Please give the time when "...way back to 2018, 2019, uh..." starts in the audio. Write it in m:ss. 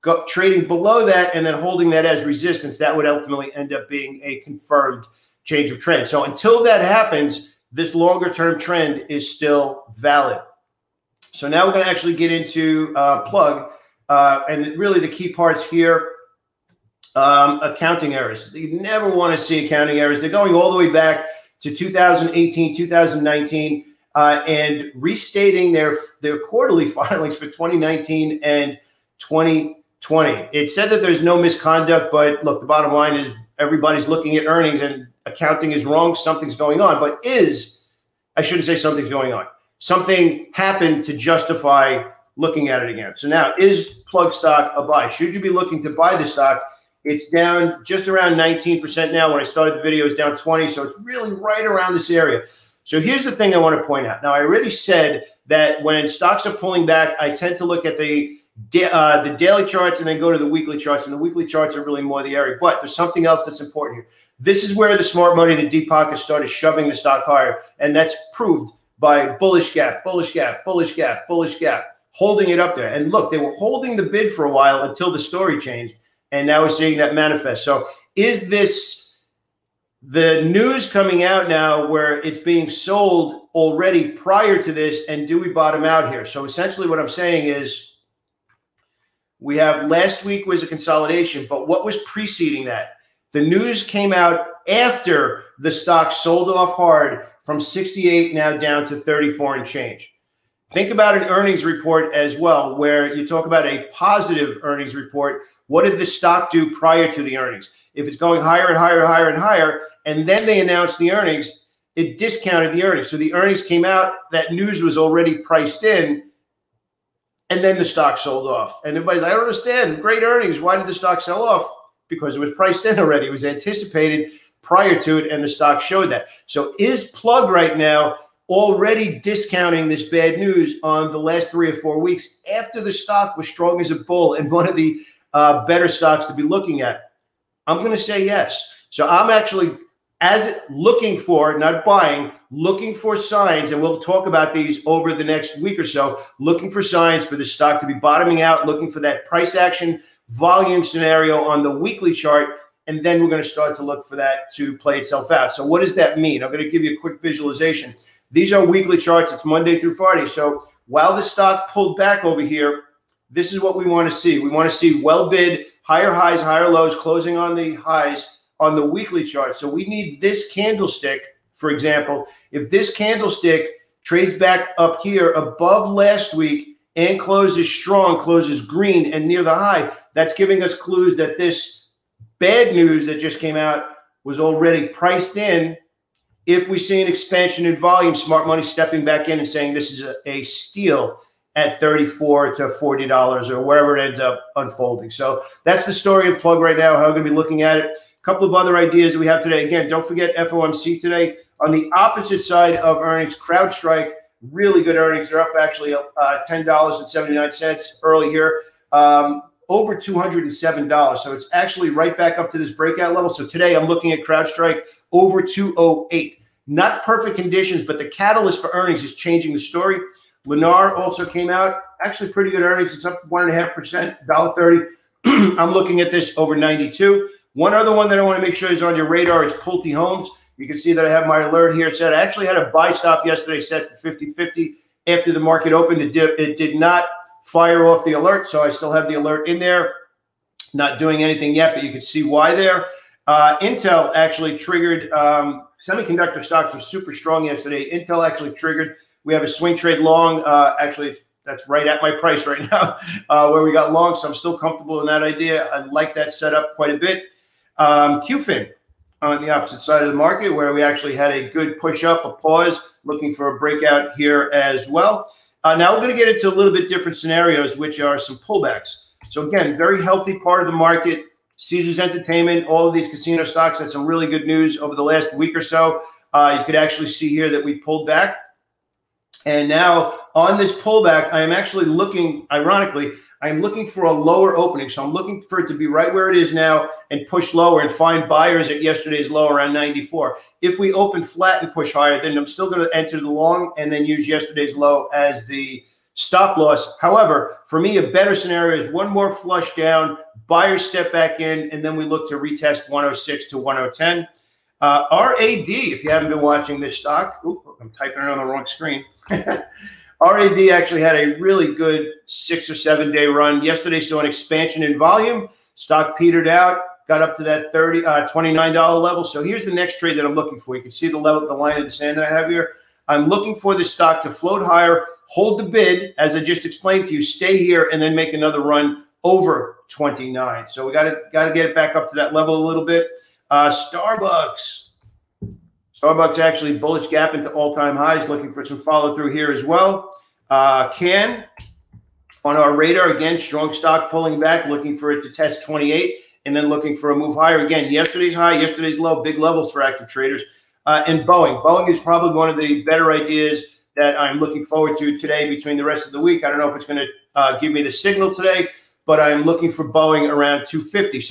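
0:20.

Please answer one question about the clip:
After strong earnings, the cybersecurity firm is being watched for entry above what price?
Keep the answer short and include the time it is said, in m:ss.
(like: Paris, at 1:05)
208, at 3:35.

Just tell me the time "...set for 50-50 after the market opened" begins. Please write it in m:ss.
3:53.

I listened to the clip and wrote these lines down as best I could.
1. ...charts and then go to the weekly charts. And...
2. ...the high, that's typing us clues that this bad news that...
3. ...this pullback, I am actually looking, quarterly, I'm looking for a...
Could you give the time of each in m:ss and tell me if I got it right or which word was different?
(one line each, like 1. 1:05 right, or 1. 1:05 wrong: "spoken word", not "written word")
1. 0:59 right
2. 2:59 wrong: "giving", not "typing"
3. 4:40 wrong: "ironically", not "quarterly".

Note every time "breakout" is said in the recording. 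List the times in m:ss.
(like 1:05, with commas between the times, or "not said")
3:32, 4:23.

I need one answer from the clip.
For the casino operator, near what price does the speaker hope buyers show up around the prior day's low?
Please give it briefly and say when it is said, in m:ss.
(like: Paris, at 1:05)
94, at 4:49.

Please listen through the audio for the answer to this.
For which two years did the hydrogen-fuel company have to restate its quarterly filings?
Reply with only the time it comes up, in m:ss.
0:27.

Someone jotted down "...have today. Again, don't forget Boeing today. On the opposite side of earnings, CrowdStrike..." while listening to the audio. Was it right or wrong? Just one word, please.
wrong.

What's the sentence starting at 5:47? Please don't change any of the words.
Yesterday's high, yesterday's low, big levels for active traders.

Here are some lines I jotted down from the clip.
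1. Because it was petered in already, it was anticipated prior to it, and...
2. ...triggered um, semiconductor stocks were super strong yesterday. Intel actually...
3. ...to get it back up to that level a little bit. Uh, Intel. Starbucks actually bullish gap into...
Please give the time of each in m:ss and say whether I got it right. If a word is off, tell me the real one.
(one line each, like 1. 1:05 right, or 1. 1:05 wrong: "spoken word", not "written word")
1. 2:02 wrong: "priced", not "petered"
2. 4:04 right
3. 5:31 wrong: "Starbucks", not "Intel".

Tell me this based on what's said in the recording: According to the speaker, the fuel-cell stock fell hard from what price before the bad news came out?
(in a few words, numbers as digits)
68.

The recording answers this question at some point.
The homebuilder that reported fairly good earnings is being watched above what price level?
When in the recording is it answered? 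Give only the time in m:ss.
3:46.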